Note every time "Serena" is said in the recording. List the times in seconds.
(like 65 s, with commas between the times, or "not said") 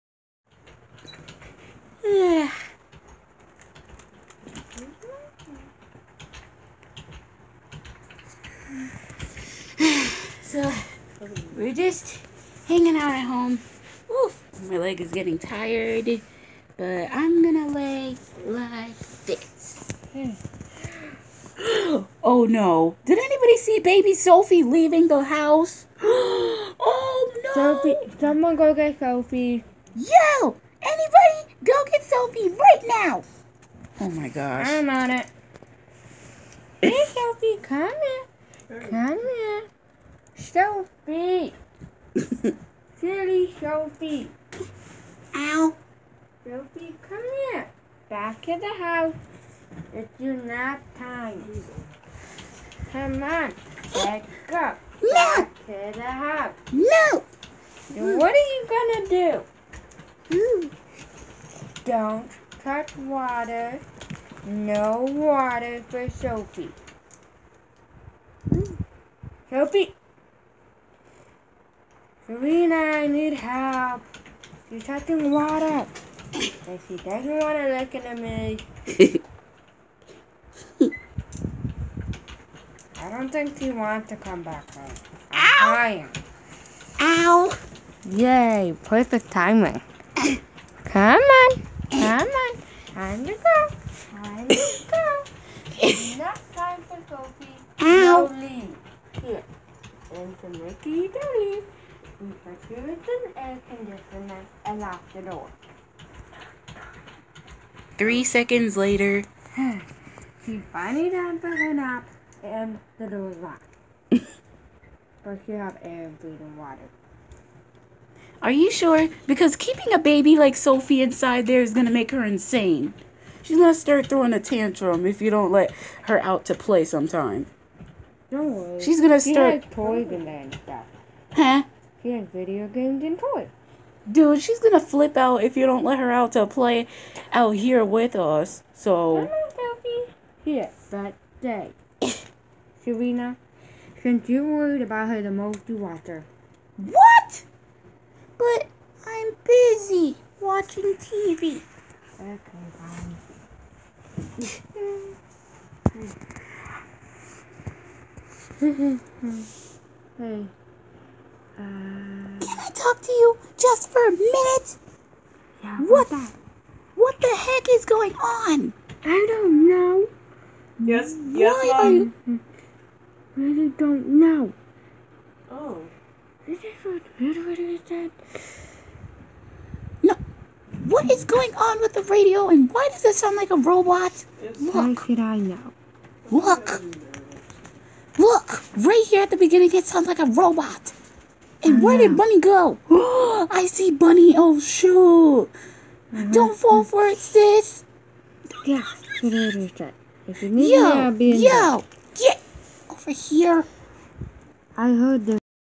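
72 s, 142 s.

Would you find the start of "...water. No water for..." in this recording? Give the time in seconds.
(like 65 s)
62 s.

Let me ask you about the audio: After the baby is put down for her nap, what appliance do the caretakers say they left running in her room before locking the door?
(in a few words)
air conditioner.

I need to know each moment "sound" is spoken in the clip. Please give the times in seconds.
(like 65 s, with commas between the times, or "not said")
183 s, 189 s.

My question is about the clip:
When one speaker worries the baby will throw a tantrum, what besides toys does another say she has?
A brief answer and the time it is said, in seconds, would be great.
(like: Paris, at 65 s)
video games, at 132 s.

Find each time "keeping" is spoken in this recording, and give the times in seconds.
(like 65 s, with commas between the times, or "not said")
119 s.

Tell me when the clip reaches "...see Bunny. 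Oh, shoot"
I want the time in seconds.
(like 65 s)
193 s.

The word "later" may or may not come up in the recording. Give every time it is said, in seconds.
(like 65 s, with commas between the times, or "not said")
108 s.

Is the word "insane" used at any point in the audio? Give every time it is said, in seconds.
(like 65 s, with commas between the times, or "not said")
122 s.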